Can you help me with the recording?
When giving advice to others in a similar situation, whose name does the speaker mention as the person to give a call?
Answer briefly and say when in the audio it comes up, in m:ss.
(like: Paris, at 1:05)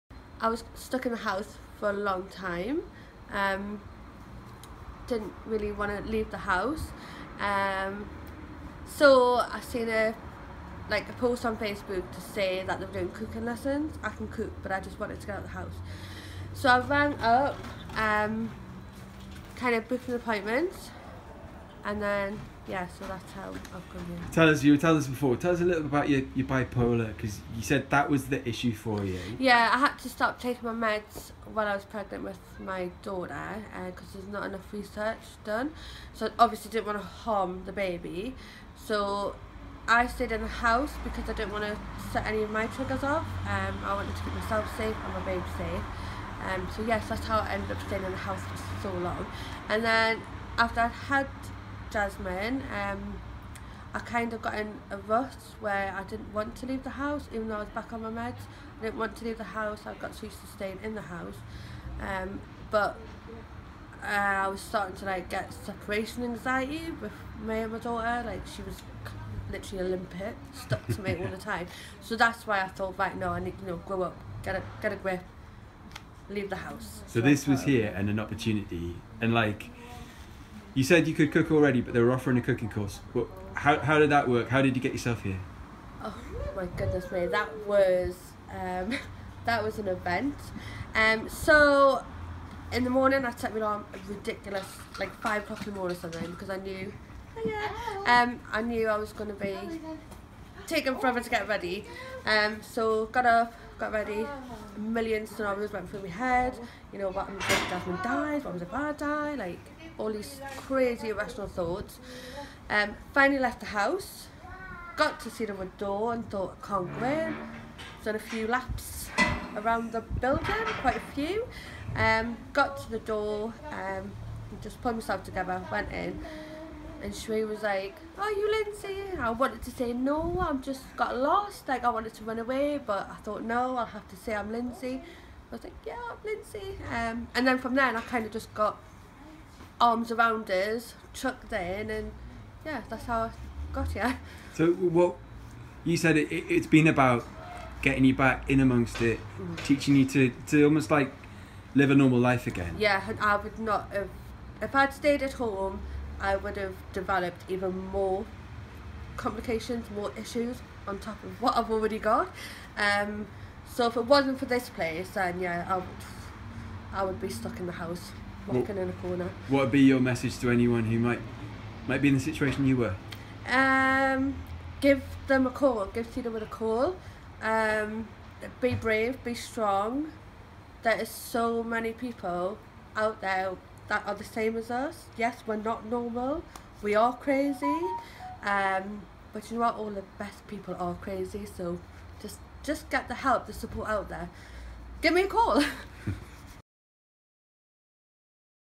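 Tina, at 2:56.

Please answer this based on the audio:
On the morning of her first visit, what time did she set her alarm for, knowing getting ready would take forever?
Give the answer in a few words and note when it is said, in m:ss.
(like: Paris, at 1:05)
5 o'clock, at 1:35.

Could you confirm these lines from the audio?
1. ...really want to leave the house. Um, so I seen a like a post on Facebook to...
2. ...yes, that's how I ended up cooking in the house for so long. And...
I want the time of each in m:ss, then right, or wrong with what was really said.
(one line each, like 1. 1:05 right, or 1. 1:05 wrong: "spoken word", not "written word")
1. 0:05 right
2. 0:46 wrong: "staying", not "cooking".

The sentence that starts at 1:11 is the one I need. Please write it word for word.
So that's why I thought, right, no, I need you know grow up, get a get a grip, leave the house.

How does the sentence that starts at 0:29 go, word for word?
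Yeah, I had to stop taking my meds while I was pregnant with my daughter because uh, there's not enough research done.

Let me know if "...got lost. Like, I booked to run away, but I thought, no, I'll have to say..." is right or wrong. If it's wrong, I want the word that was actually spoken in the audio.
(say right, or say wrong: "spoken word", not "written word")
wrong: "wanted", not "booked".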